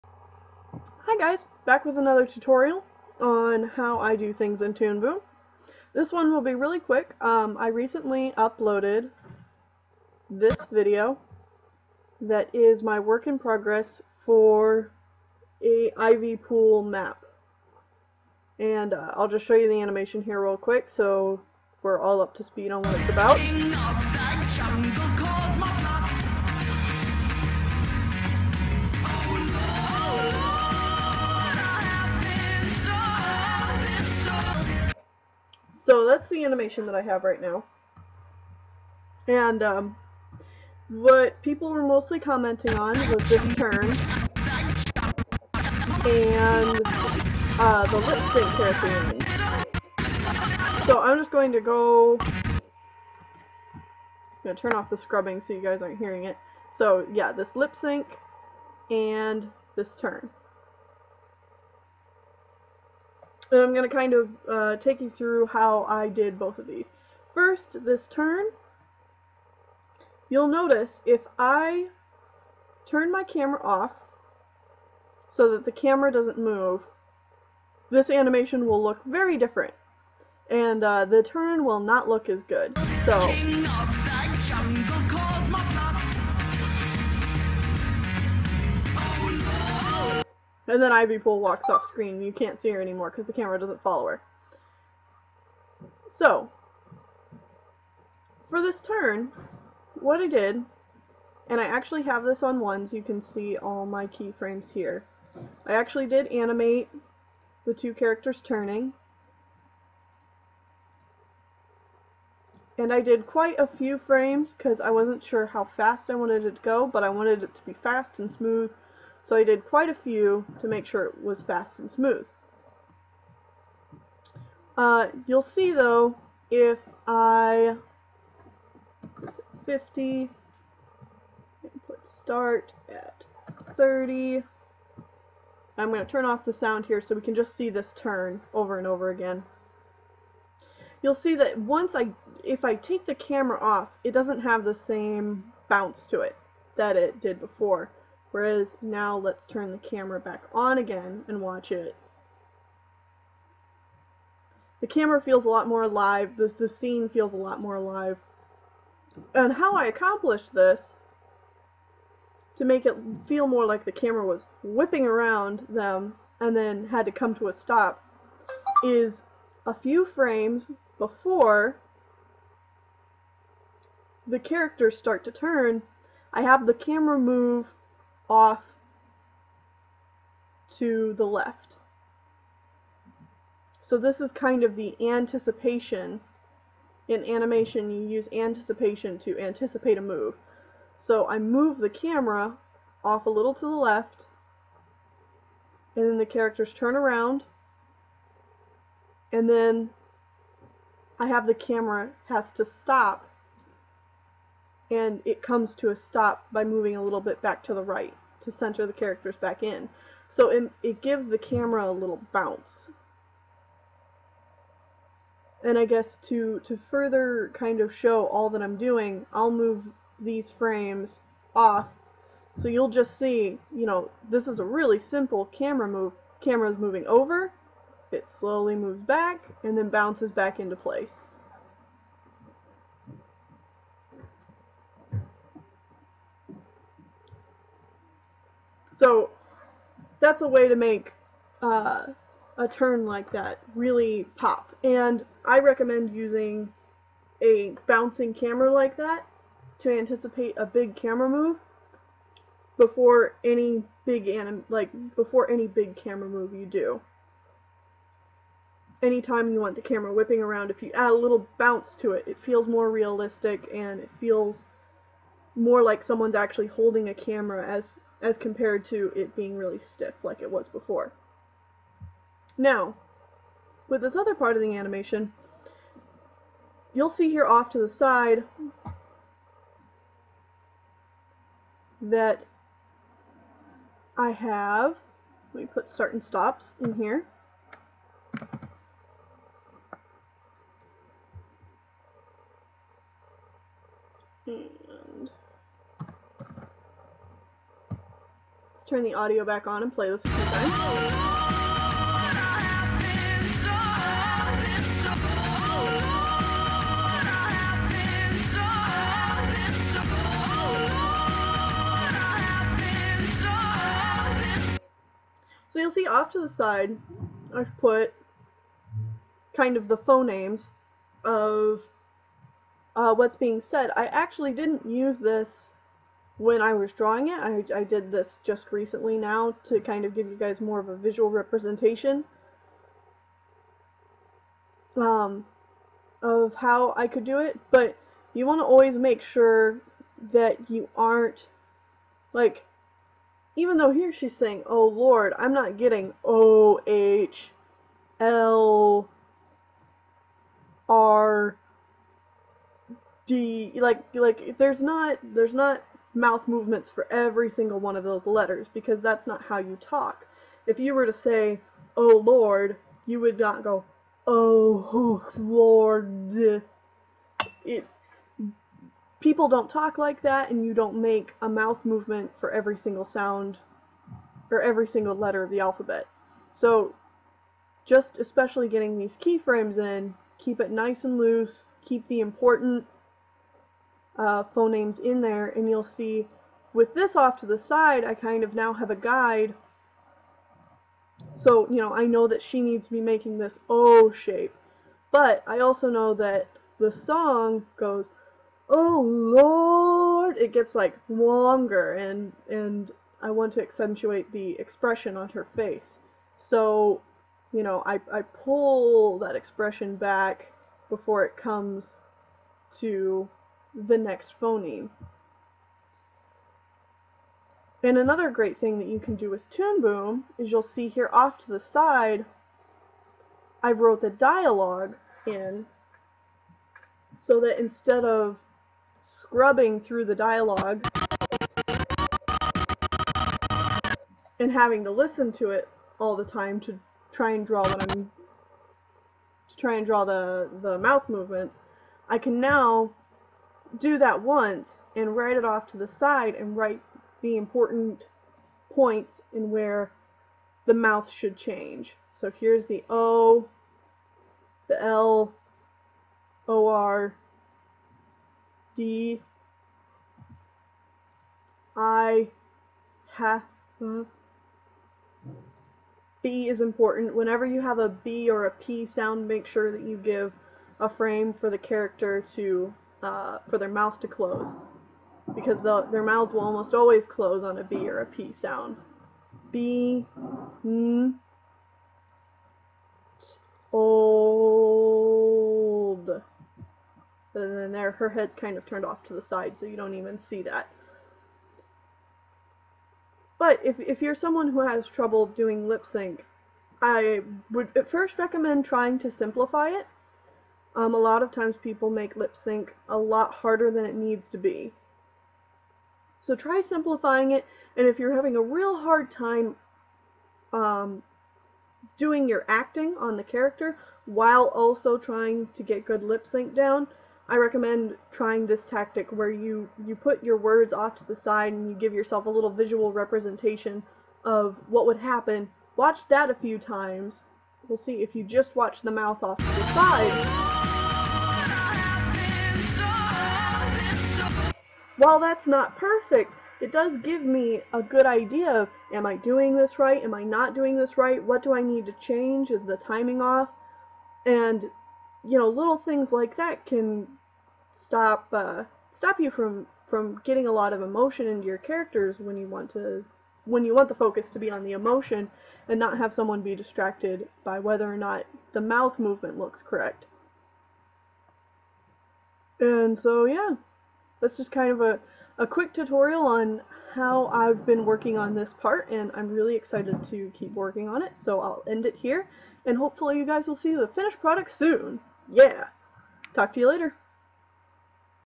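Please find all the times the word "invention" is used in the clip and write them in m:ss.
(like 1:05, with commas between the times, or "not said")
not said.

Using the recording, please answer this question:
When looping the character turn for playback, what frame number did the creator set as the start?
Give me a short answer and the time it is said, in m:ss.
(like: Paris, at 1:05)
30, at 2:11.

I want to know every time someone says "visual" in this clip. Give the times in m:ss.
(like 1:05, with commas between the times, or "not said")
5:30, 8:42.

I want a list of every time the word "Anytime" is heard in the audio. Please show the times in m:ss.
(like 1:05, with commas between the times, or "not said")
4:19.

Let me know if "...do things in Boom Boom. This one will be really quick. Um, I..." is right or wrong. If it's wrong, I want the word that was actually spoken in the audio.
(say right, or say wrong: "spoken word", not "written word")
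wrong: "Toon", not "Boom".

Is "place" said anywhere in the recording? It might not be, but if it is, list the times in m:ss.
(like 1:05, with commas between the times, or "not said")
3:50.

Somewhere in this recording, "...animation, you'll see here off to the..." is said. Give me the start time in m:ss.
4:34.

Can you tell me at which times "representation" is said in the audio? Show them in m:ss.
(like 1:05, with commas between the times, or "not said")
5:31, 8:42.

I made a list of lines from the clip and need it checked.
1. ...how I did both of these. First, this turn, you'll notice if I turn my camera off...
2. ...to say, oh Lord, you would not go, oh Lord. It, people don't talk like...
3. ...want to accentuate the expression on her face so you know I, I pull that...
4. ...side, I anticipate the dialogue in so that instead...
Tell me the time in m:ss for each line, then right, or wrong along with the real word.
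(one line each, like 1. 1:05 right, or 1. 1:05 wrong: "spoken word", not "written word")
1. 1:05 right
2. 6:01 right
3. 6:43 right
4. 7:01 wrong: "wrote", not "anticipate".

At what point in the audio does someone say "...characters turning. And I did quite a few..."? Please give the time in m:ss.
1:47.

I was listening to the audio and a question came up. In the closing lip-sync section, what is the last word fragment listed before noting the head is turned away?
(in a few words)
old.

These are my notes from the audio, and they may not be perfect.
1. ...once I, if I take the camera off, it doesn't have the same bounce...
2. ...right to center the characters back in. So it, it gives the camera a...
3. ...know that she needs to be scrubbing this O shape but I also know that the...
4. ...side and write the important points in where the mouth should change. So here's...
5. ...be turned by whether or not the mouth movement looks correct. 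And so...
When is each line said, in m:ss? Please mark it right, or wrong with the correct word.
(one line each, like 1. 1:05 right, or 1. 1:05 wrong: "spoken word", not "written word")
1. 2:21 right
2. 3:27 right
3. 6:32 wrong: "making", not "scrubbing"
4. 7:25 right
5. 9:16 wrong: "distracted", not "turned".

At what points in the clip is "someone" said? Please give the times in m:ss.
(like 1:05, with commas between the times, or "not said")
4:26, 8:14, 9:16.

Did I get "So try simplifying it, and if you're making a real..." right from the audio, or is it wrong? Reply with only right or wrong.
wrong.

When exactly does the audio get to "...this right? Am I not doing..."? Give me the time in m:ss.
8:59.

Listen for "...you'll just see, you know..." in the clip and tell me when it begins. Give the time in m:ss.
3:42.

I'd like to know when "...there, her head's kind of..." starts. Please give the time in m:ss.
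8:07.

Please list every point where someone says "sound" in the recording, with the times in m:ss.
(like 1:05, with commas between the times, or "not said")
2:16, 6:13, 7:48, 7:58.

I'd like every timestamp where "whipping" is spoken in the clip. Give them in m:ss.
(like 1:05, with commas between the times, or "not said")
2:44, 4:20.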